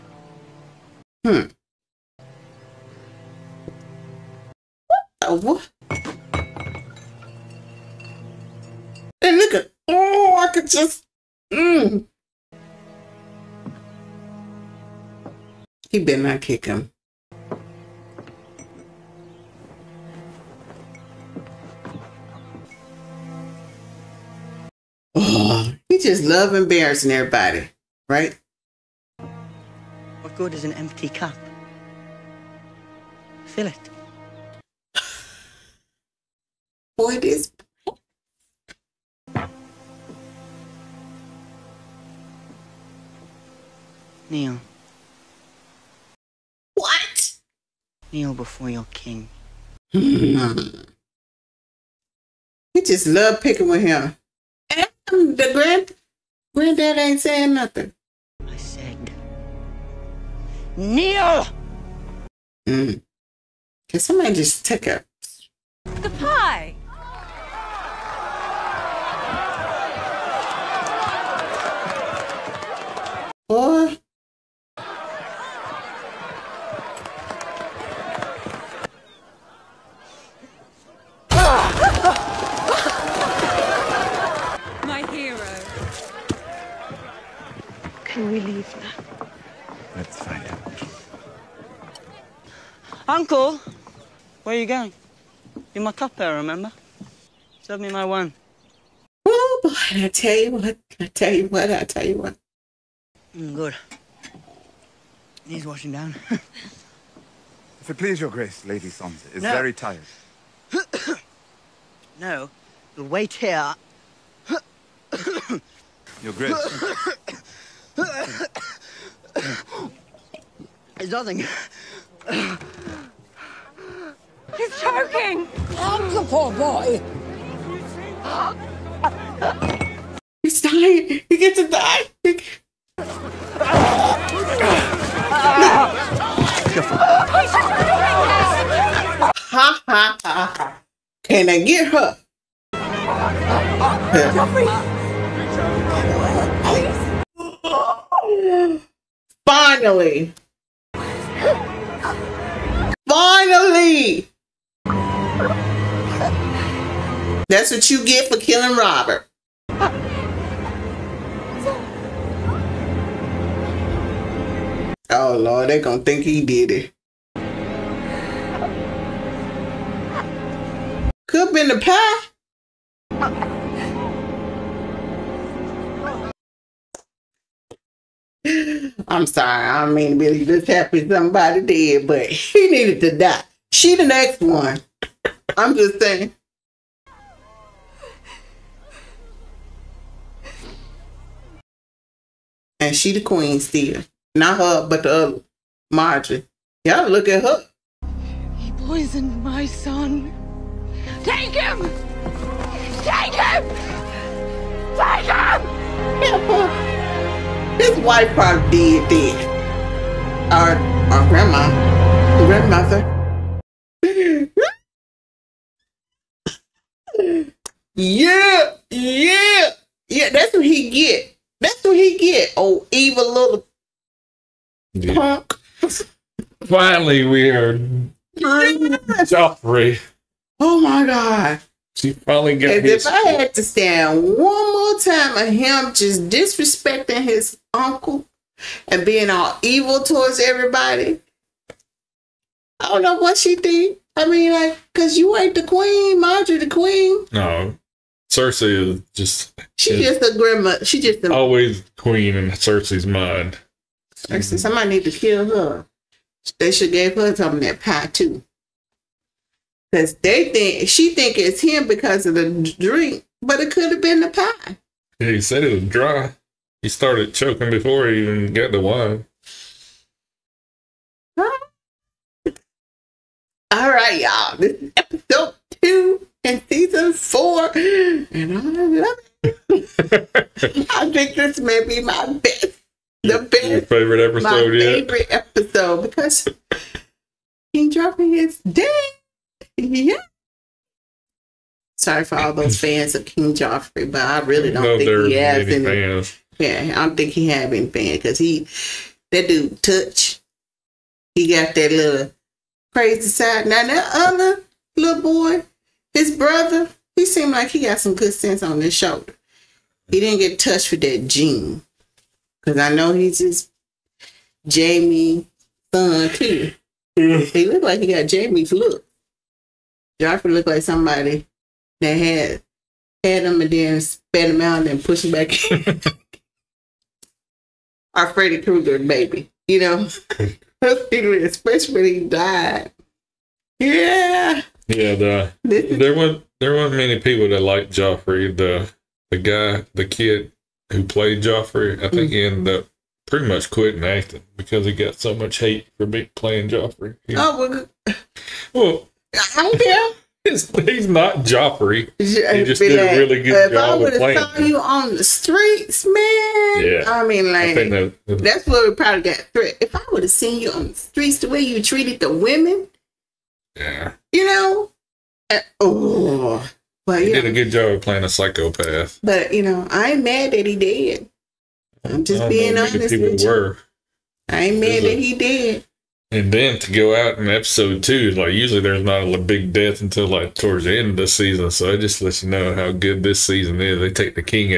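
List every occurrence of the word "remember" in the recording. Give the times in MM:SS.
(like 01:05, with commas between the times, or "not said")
01:36.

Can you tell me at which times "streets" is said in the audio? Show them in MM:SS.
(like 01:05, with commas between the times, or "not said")
05:55, 06:00.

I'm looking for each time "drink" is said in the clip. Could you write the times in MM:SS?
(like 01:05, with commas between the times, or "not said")
04:22.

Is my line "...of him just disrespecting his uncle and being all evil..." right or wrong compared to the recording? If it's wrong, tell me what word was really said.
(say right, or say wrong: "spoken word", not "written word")
right.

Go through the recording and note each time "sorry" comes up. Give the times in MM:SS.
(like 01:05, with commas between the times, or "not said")
02:59, 04:51.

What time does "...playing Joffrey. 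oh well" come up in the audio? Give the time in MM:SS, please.
05:46.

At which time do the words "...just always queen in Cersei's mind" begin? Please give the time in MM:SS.
04:10.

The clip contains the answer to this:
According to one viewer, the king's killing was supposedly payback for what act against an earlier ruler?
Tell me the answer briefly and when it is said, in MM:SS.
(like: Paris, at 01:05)
Killing Robert, at 02:38.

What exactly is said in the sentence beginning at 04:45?
favorite episode because King Joffrey is dead.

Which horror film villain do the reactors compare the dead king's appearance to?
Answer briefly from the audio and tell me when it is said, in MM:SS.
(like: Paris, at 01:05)
Freddy Krueger, at 05:28.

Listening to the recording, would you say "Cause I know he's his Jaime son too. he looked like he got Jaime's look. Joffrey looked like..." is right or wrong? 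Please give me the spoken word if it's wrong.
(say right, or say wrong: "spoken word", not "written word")
right.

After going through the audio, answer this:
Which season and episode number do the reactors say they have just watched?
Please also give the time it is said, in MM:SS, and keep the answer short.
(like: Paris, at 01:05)
Episode 2, season 4, at 04:34.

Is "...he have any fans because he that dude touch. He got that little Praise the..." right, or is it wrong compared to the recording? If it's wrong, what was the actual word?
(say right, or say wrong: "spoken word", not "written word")
right.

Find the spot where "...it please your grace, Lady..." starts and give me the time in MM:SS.
01:47.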